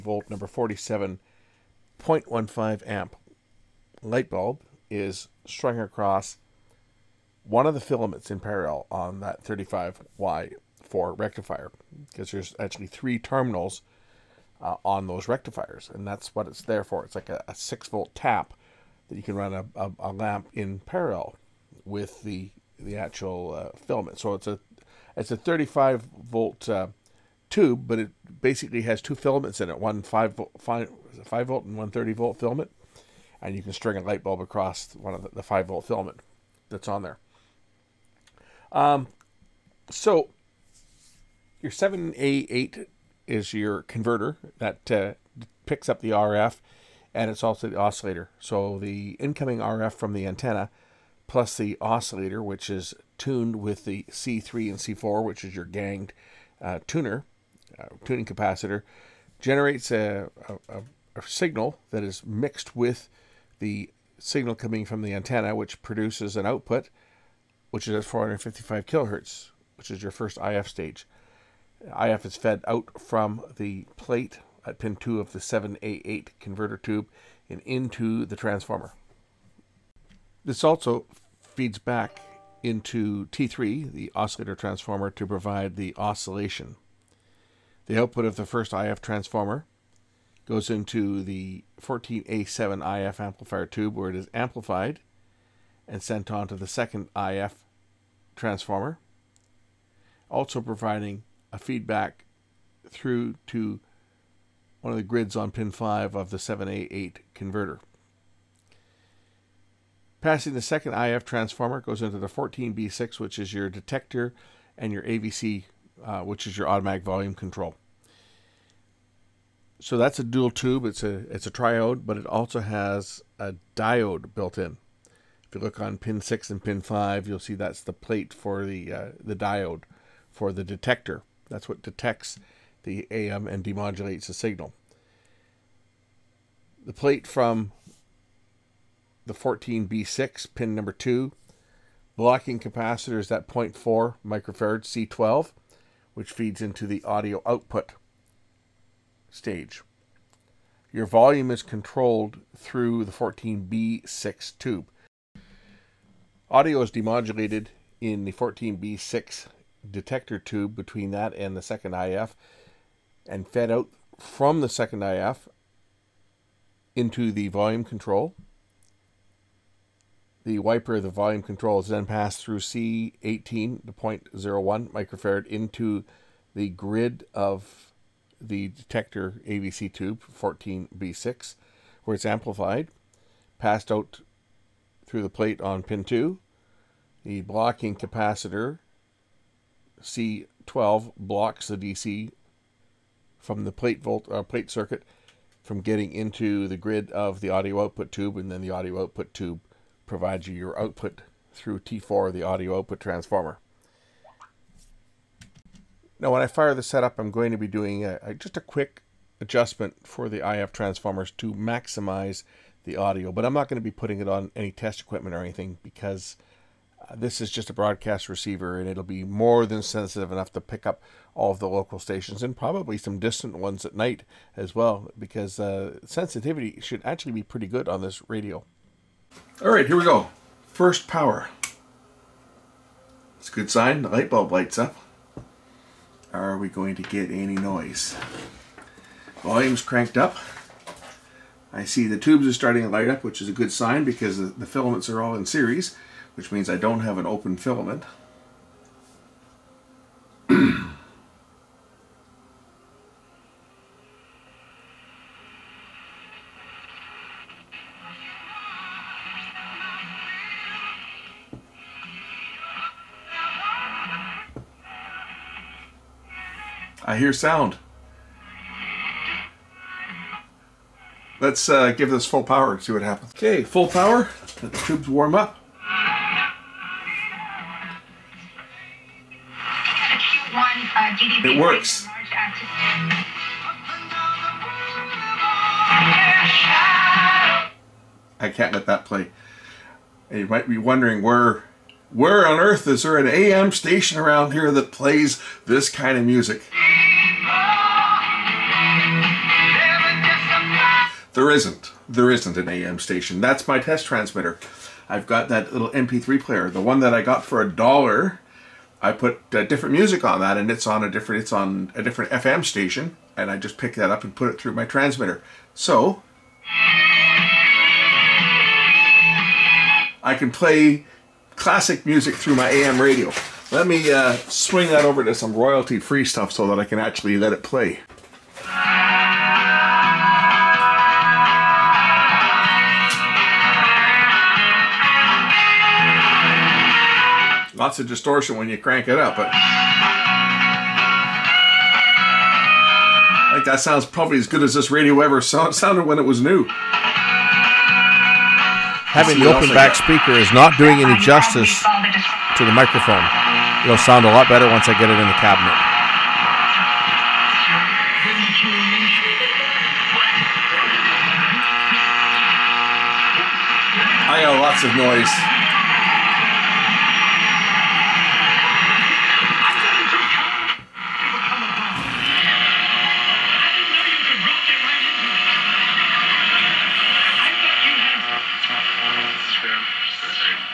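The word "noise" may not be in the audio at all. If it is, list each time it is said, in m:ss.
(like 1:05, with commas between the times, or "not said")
3:57, 6:04.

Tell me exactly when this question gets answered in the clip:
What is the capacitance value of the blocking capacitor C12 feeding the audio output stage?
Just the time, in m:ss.
2:23.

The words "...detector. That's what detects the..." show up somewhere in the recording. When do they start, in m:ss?
2:10.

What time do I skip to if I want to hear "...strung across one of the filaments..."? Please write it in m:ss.
0:05.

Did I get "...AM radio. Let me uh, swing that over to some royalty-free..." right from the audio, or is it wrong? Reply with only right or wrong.
right.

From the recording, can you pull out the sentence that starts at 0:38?
Um, so your 7A8 is your converter that uh, picks up the RF and it's also the oscillator.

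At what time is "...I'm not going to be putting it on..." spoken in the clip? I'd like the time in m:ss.
3:33.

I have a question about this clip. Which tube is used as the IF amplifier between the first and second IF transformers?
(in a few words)
14A7.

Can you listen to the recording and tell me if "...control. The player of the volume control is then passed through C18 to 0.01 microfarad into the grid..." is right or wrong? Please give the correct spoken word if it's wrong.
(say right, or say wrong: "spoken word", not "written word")
wrong: "wiper", not "player".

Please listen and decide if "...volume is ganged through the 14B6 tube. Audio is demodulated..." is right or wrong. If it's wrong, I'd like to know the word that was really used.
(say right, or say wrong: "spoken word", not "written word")
wrong: "controlled", not "ganged".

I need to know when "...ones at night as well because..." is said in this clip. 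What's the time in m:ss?
3:43.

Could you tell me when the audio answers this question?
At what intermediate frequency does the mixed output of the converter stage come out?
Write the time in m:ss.
1:08.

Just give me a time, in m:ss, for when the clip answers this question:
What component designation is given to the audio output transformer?
3:21.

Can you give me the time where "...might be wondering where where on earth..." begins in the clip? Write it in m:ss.
4:50.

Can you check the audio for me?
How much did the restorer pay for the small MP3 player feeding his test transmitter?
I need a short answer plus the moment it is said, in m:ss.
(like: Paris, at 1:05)
a dollar, at 5:07.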